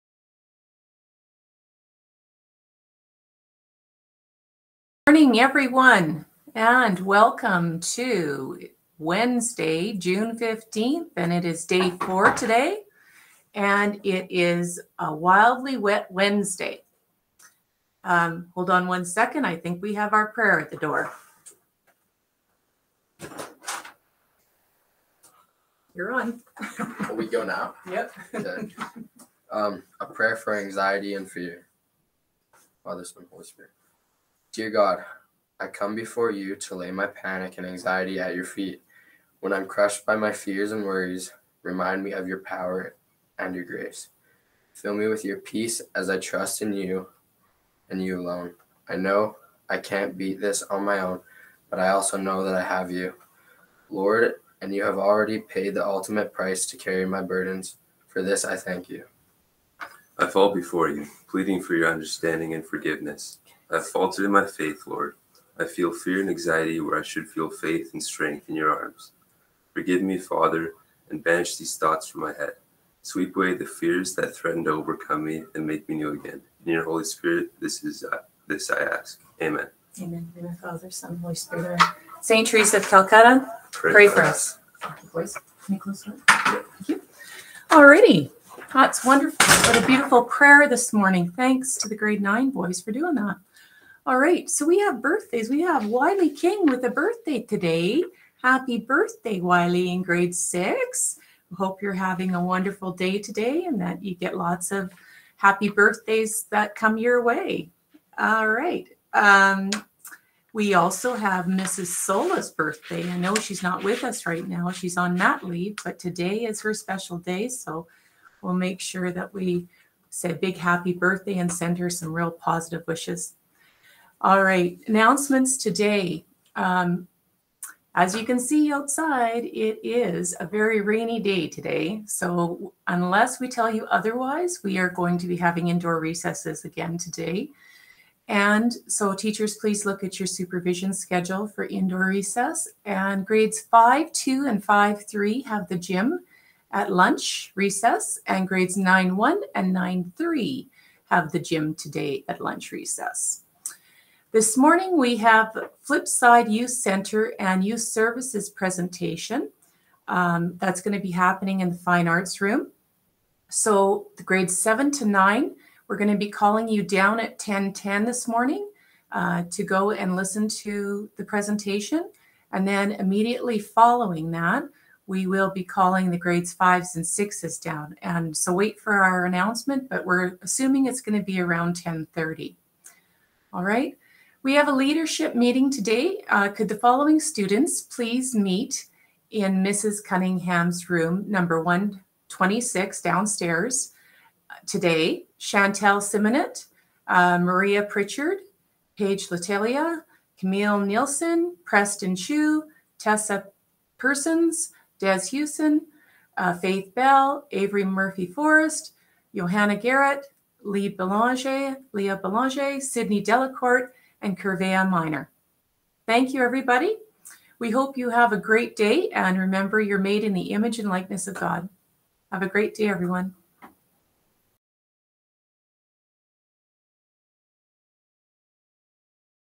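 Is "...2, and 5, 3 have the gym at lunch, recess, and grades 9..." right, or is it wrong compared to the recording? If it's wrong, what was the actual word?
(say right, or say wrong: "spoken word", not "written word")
right.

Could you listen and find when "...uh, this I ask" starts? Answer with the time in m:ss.
1:18.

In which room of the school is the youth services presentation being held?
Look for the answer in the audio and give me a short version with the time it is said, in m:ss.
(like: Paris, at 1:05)
Fine Arts Room, at 2:41.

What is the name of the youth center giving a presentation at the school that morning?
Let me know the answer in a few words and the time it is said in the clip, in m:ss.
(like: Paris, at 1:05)
Flipside Youth Center, at 2:35.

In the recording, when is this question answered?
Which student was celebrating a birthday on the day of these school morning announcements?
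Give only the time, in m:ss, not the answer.
1:35.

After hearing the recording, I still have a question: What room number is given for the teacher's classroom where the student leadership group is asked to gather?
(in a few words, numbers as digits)
126.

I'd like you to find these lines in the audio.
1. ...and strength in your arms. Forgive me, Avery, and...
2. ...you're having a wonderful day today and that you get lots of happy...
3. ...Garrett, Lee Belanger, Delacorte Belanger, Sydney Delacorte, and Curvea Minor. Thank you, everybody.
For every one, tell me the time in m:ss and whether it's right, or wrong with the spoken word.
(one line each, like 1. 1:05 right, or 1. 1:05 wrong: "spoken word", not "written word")
1. 1:07 wrong: "Father", not "Avery"
2. 1:41 right
3. 3:29 wrong: "Leah", not "Delacorte".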